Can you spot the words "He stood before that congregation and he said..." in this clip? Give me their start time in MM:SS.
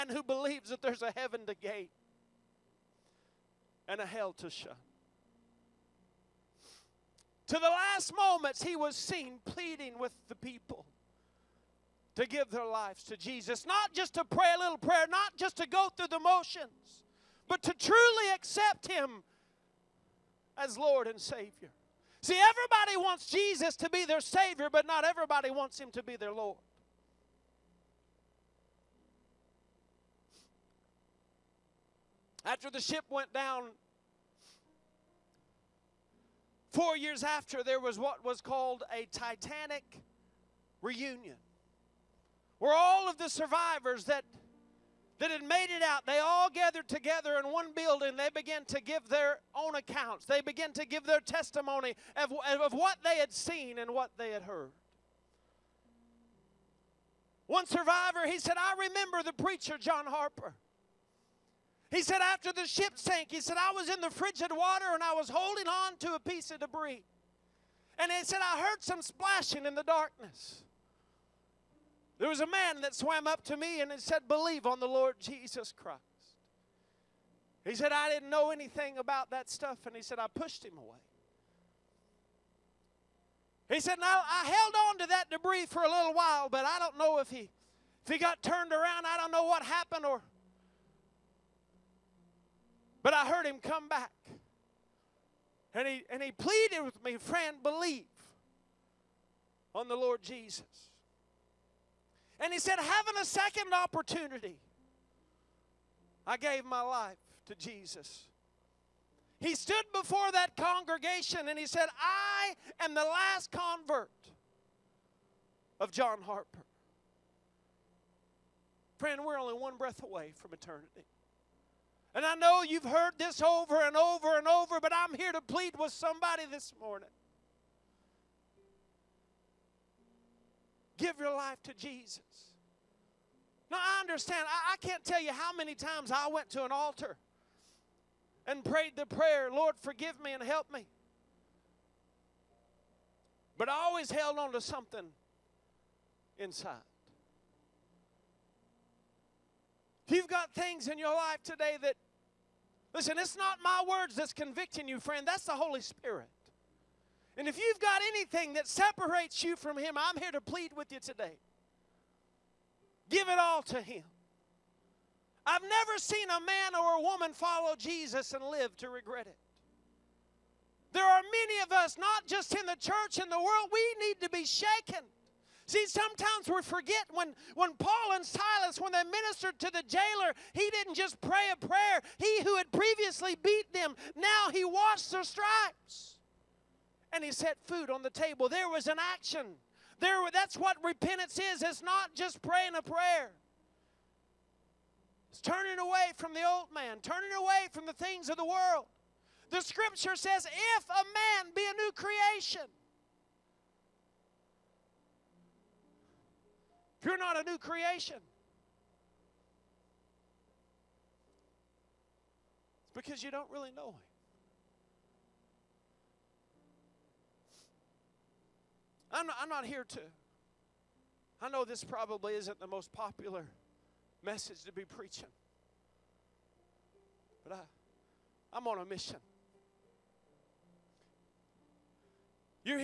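01:49.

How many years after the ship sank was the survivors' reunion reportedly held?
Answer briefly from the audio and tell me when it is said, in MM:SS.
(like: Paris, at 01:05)
4, at 00:36.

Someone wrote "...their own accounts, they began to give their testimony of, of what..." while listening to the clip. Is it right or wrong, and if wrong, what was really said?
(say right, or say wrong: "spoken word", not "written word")
right.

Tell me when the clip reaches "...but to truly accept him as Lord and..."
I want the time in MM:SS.
00:17.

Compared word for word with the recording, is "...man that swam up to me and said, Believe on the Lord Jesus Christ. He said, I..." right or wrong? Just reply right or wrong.
right.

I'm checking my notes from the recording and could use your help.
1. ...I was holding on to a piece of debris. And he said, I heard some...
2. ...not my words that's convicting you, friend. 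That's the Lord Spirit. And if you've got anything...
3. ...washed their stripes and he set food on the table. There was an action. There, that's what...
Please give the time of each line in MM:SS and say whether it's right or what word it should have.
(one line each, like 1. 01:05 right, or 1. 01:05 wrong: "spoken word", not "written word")
1. 01:05 right
2. 02:33 wrong: "Holy", not "Lord"
3. 03:04 right.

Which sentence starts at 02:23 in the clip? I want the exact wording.
But I always held on to something inside.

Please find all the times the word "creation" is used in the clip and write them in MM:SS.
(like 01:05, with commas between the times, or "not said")
03:21, 03:27.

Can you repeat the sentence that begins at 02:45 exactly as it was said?
I've never seen a man or a woman follow Jesus and live to regret it.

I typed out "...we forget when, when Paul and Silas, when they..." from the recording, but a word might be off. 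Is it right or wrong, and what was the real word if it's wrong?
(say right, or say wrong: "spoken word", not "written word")
right.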